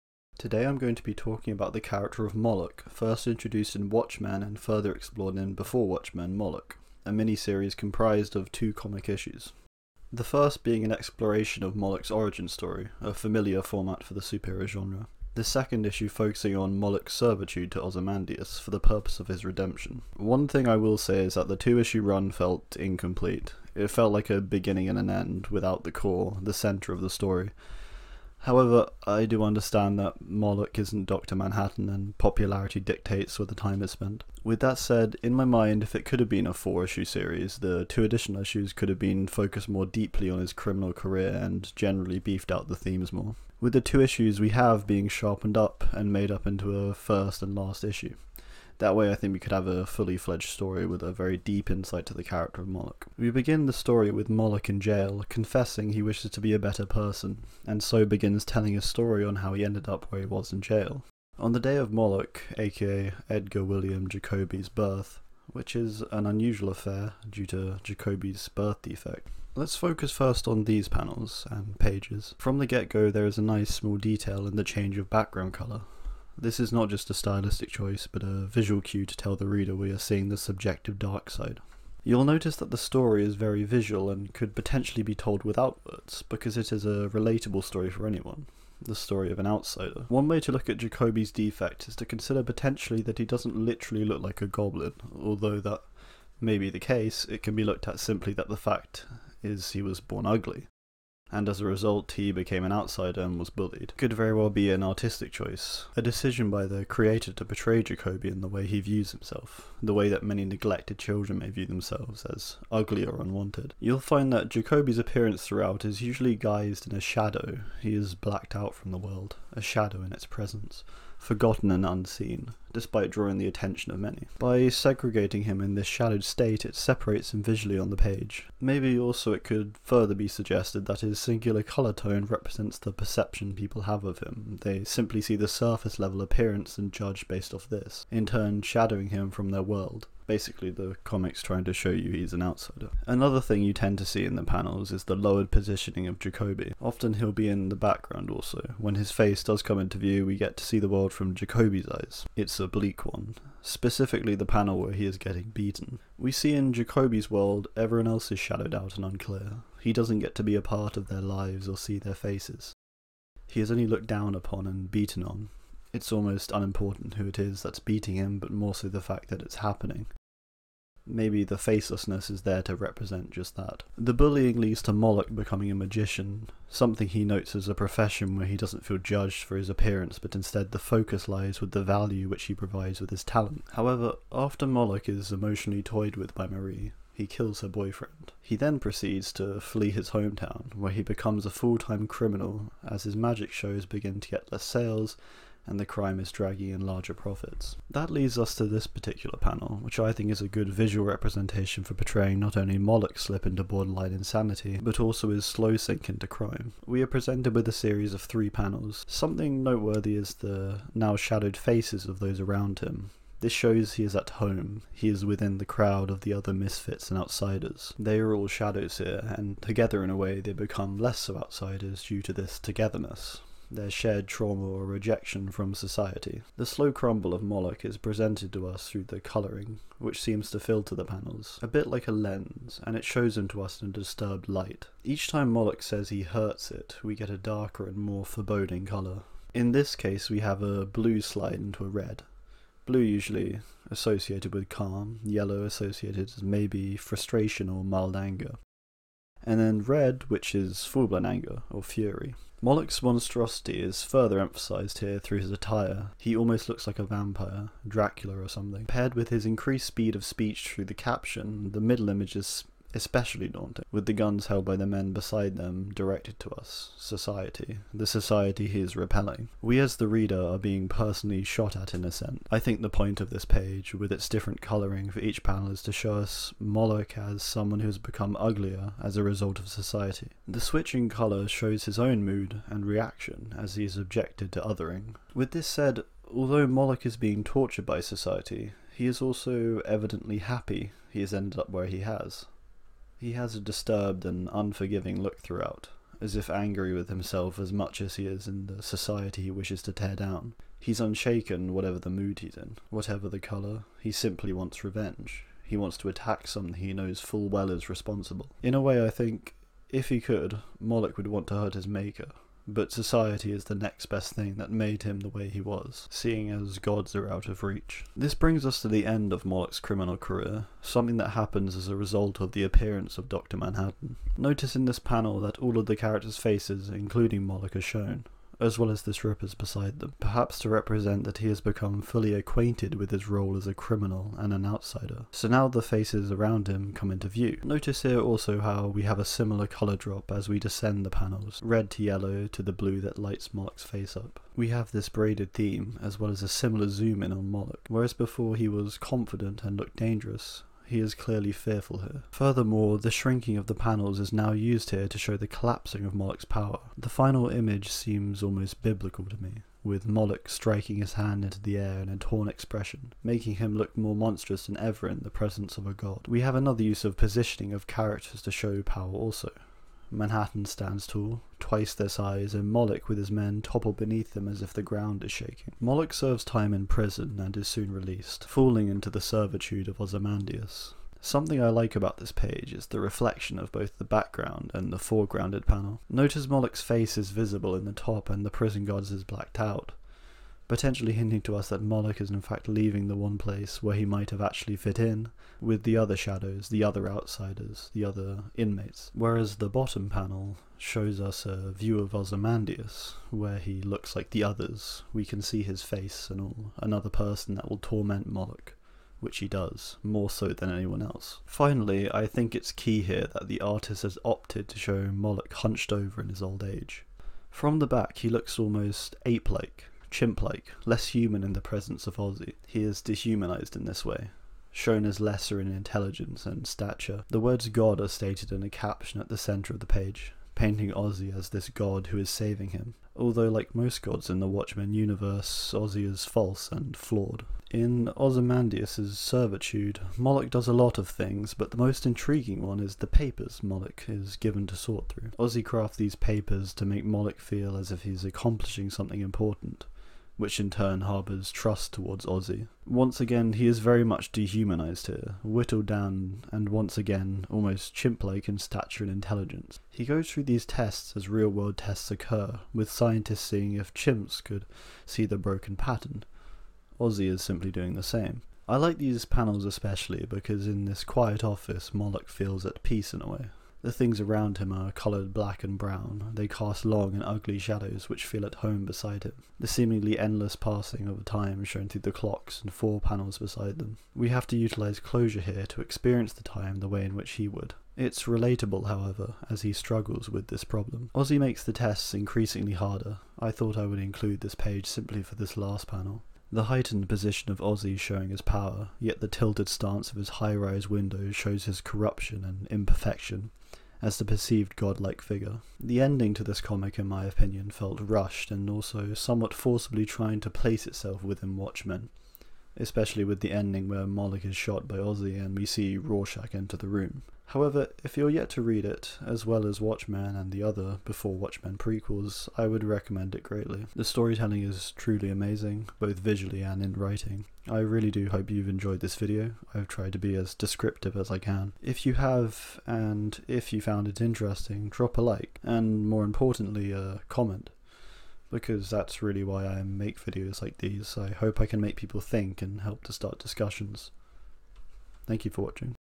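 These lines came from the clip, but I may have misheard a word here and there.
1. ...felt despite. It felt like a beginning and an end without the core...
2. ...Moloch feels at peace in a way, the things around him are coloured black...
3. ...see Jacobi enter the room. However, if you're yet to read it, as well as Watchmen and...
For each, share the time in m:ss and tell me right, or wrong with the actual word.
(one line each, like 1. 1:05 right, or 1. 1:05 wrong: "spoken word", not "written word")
1. 0:22 wrong: "incomplete", not "despite"
2. 7:51 right
3. 8:35 wrong: "Rorschach", not "Jacobi".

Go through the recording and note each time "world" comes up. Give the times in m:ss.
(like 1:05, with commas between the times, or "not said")
1:58, 2:19, 2:30, 2:37, 7:41.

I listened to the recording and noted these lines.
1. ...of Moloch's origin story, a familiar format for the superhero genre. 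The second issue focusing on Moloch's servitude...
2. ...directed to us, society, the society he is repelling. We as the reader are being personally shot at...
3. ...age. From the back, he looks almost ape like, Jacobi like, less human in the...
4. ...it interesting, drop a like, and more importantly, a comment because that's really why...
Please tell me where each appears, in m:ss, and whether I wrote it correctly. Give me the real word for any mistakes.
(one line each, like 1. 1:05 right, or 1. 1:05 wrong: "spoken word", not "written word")
1. 0:11 right
2. 4:25 right
3. 6:56 wrong: "Chimp", not "Jacobi"
4. 8:54 right.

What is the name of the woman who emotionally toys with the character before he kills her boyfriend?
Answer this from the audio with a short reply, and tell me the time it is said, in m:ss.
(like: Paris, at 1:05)
Marie, at 3:06.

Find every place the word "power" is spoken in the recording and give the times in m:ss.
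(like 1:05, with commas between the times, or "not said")
5:56, 6:08, 8:18.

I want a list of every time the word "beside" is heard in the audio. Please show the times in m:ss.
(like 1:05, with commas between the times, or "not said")
4:25, 5:29, 7:58, 8:03.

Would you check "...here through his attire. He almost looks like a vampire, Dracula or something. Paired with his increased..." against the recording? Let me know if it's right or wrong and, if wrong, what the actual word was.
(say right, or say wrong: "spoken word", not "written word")
right.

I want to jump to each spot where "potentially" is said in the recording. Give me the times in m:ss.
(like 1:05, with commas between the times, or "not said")
1:24, 1:32, 6:30.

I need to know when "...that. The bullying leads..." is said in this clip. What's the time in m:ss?
2:53.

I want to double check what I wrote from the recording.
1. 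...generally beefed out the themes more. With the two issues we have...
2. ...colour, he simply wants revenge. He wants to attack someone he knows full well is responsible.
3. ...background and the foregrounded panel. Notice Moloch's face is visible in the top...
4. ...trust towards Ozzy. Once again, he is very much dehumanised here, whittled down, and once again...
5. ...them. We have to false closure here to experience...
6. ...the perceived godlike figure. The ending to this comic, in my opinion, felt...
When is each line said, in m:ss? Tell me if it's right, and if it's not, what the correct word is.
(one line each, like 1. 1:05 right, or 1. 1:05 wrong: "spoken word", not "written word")
1. 0:41 right
2. 5:03 right
3. 6:24 right
4. 7:31 right
5. 8:03 wrong: "utilise", not "false"
6. 8:24 right.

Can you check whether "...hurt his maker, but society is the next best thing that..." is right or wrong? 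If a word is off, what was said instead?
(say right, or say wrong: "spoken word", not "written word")
right.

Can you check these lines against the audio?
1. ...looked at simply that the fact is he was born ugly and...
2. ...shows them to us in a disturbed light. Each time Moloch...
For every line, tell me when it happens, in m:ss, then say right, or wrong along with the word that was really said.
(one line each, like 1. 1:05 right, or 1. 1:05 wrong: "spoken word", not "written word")
1. 1:37 right
2. 3:53 right.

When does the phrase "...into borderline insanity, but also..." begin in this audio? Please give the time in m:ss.
3:23.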